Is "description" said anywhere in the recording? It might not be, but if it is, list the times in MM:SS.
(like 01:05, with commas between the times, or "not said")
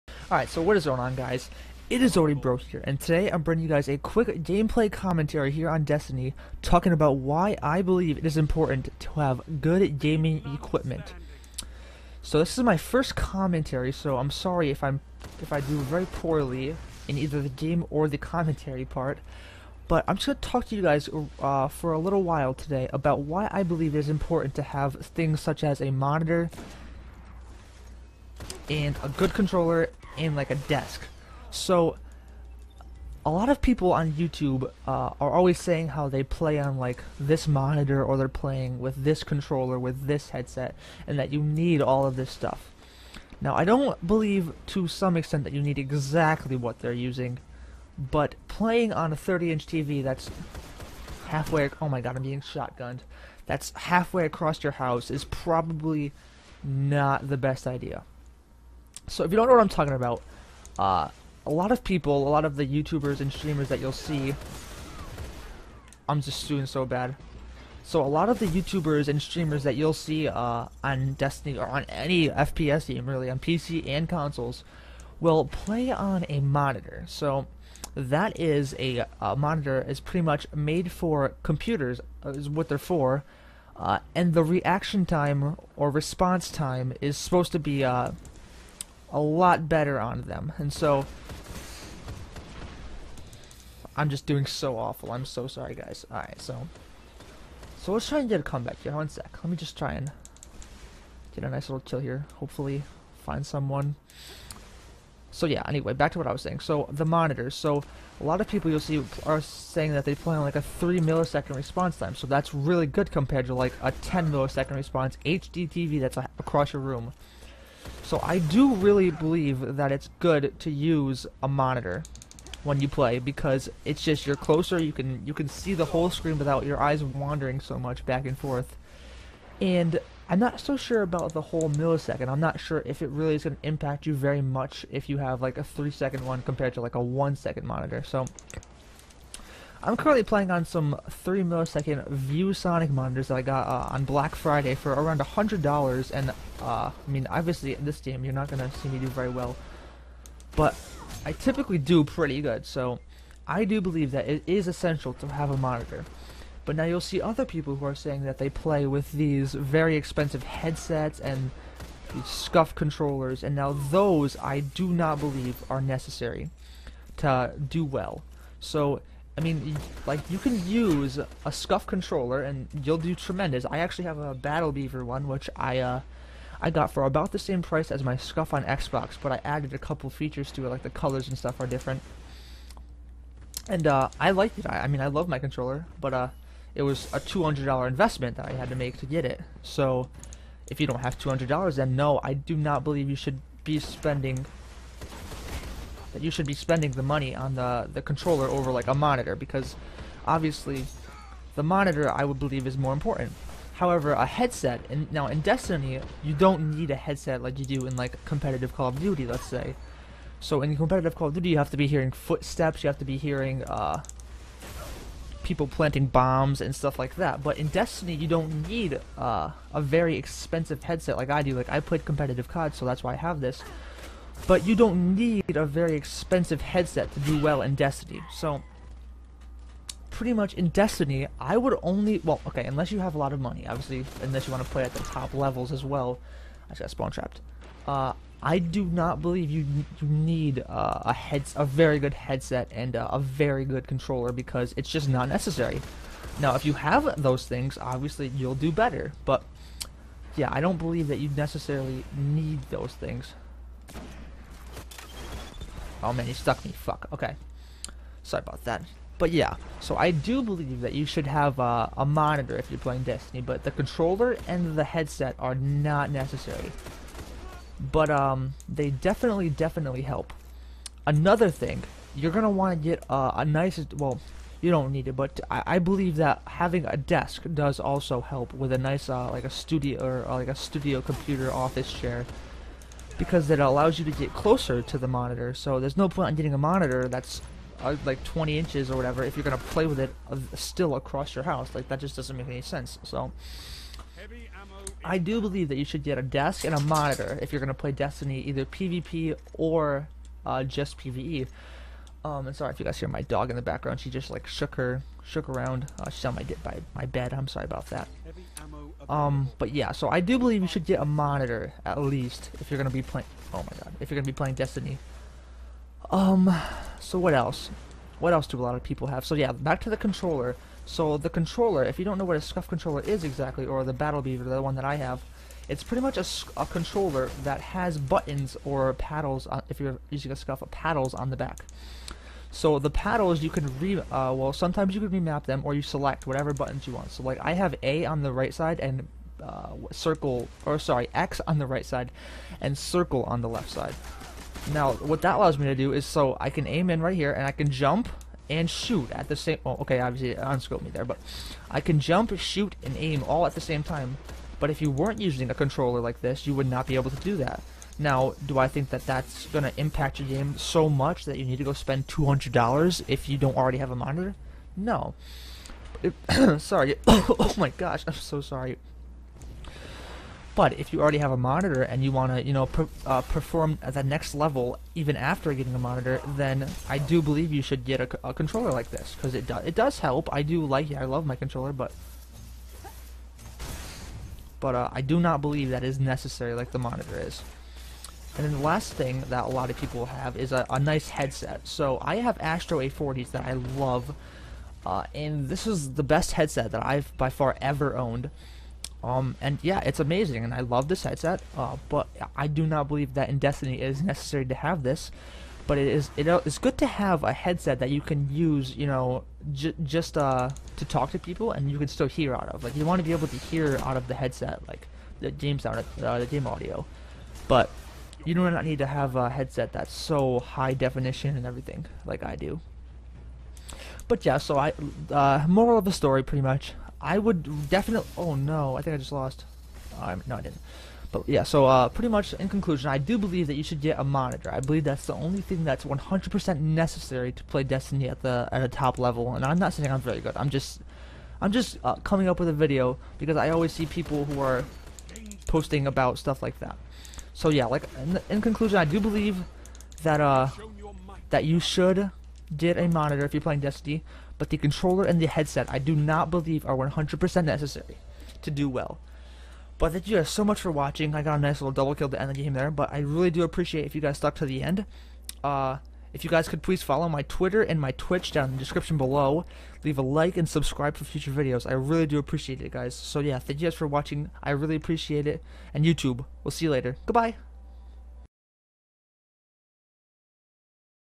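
07:48.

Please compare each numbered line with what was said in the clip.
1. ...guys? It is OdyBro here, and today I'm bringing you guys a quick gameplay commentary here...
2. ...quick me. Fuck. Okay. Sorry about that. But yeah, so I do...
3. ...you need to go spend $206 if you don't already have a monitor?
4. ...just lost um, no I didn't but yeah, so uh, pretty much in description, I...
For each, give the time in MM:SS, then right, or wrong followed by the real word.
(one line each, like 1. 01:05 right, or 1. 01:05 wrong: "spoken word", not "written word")
1. 00:01 right
2. 04:16 wrong: "stuck", not "quick"
3. 06:01 wrong: "200", not "206"
4. 07:08 wrong: "conclusion", not "description".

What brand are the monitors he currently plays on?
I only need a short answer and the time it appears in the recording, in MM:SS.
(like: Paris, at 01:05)
ViewSonic, at 02:22.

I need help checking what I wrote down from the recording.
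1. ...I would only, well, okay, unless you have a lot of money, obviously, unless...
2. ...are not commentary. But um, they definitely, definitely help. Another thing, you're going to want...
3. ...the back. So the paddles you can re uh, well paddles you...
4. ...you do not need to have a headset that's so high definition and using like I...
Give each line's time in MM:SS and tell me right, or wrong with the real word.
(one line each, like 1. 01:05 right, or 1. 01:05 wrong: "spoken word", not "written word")
1. 03:51 right
2. 04:25 wrong: "necessary", not "commentary"
3. 05:31 wrong: "sometimes", not "paddles"
4. 06:58 wrong: "everything", not "using".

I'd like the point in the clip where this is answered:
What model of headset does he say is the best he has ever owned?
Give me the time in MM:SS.
06:32.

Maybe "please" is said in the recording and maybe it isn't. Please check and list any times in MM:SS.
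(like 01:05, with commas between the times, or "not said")
07:46.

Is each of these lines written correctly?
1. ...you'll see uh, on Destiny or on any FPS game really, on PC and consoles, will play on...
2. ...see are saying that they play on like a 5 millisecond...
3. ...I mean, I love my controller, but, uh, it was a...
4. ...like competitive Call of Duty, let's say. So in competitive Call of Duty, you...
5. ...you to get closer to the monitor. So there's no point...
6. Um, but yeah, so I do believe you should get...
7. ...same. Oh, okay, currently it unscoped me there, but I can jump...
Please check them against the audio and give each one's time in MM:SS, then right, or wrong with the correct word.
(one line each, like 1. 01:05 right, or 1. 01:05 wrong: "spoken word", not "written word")
1. 01:09 right
2. 01:48 wrong: "3", not "5"
3. 03:04 right
4. 03:27 right
5. 04:43 right
6. 05:09 right
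7. 05:49 wrong: "obviously", not "currently".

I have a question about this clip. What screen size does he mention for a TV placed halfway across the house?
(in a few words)
30 inch.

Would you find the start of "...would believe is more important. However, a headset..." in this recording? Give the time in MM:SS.
03:22.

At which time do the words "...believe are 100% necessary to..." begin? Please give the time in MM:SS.
07:36.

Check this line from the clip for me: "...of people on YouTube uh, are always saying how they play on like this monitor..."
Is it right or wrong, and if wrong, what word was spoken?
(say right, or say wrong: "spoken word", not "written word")
right.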